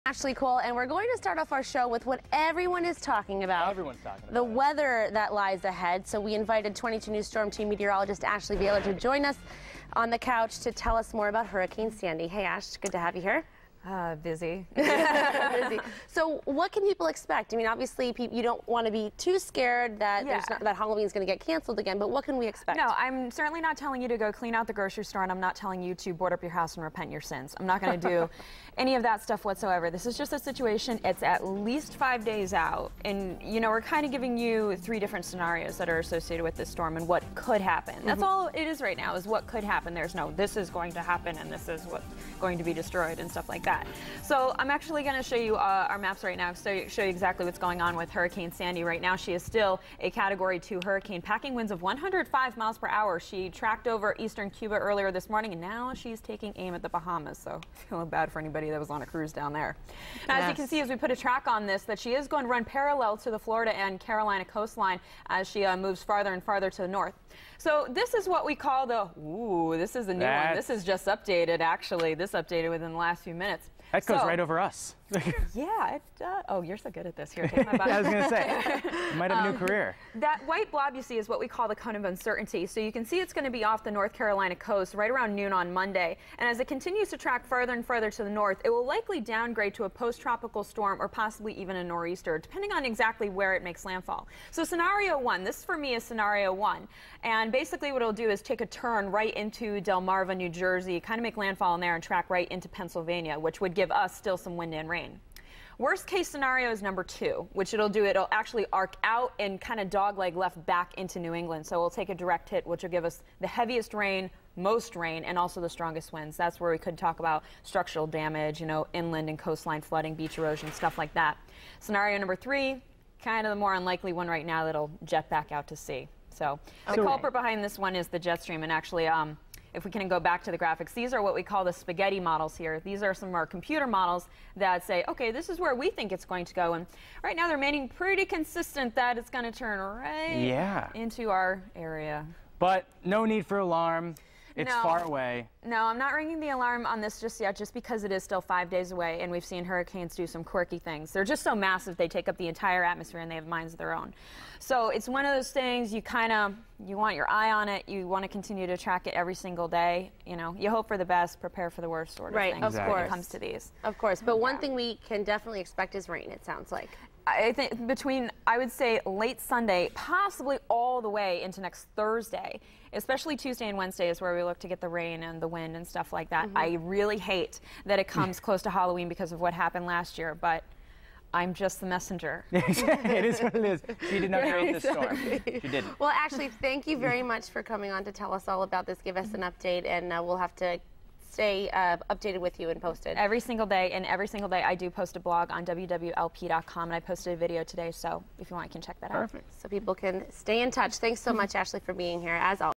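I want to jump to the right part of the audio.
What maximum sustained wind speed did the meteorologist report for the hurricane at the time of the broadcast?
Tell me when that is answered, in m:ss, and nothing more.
0:51.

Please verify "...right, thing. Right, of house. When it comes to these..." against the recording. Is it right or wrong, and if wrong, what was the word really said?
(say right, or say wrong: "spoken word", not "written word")
wrong: "course", not "house".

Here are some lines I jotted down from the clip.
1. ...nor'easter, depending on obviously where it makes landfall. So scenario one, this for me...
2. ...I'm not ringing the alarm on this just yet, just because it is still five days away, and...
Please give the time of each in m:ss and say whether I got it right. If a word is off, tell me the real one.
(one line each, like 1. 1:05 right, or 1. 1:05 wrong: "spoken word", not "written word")
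1. 1:31 wrong: "exactly", not "obviously"
2. 2:25 right.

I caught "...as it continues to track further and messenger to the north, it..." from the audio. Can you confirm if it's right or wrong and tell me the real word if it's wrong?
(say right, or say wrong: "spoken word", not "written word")
wrong: "further", not "messenger".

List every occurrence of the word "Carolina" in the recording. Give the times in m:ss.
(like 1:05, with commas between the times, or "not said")
1:03, 1:24.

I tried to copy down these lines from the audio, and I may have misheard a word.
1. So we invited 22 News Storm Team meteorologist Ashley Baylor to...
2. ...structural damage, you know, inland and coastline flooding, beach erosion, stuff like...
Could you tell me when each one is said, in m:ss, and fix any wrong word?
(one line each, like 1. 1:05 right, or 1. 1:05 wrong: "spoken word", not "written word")
1. 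0:06 right
2. 1:57 right.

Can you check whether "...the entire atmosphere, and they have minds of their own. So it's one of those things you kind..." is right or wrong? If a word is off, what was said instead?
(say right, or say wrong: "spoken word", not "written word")
right.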